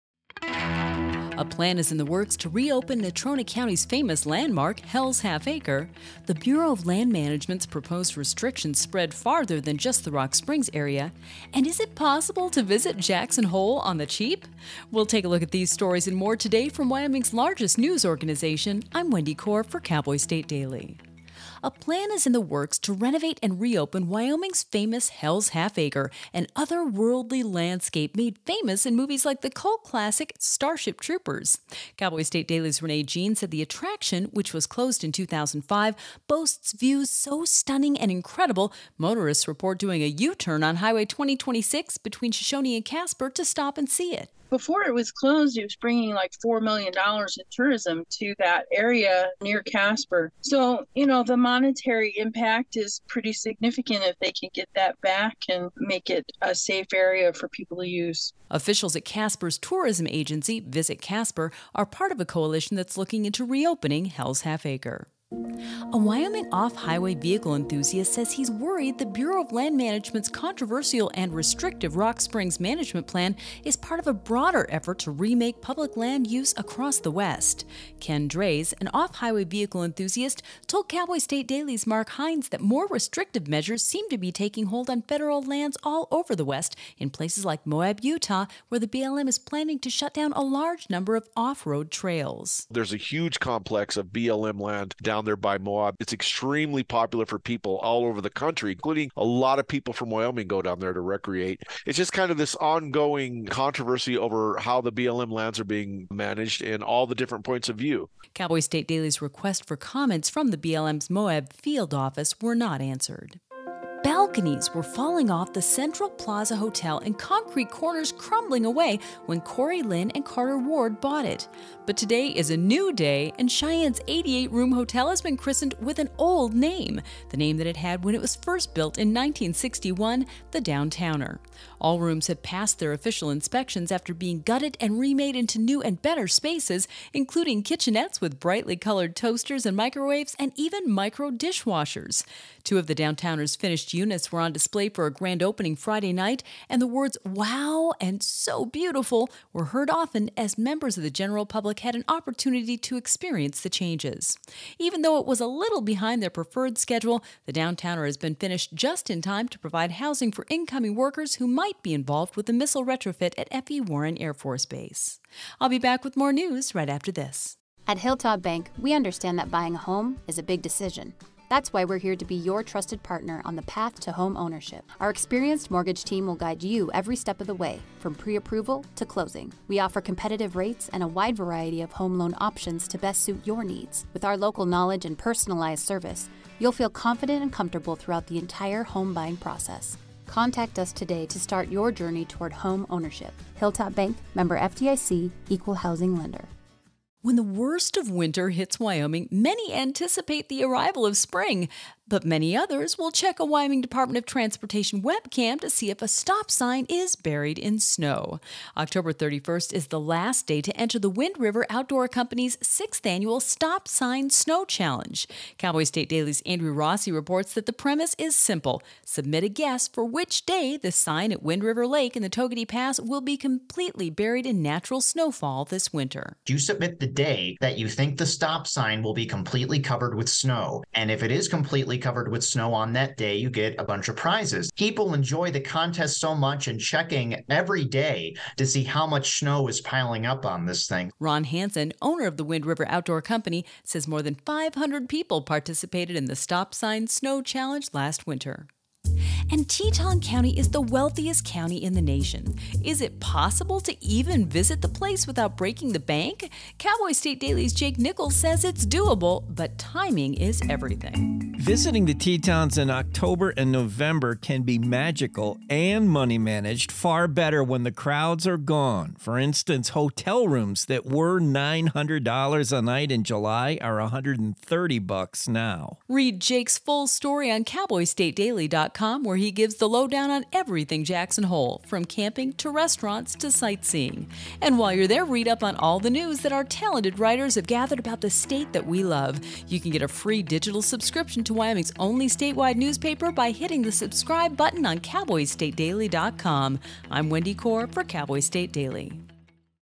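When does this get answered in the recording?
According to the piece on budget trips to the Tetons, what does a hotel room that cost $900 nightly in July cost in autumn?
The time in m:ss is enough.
4:33.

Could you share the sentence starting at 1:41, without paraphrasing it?
It's just kind of this ongoing controversy over how the BLM lands are being managed and all the different points of view.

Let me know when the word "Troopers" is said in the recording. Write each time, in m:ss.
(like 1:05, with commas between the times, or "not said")
0:30.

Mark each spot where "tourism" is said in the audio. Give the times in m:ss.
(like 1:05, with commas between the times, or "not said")
0:47, 0:59.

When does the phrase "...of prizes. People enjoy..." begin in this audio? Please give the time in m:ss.
3:54.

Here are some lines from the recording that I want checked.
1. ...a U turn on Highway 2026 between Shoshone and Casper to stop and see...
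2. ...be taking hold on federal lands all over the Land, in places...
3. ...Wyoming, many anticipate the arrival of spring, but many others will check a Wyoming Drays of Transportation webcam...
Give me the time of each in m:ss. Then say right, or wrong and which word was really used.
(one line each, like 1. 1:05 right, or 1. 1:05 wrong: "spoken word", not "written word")
1. 0:40 right
2. 1:24 wrong: "West", not "Land"
3. 3:18 wrong: "Department", not "Drays".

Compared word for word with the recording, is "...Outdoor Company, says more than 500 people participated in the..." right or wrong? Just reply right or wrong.
right.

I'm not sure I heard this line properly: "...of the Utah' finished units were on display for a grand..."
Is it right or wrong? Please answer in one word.
wrong.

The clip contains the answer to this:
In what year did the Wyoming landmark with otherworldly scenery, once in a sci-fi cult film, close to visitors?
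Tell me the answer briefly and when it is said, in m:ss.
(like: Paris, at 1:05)
2005, at 0:35.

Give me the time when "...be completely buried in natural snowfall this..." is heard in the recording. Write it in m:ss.
3:43.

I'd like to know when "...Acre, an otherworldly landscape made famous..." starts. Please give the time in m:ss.
0:25.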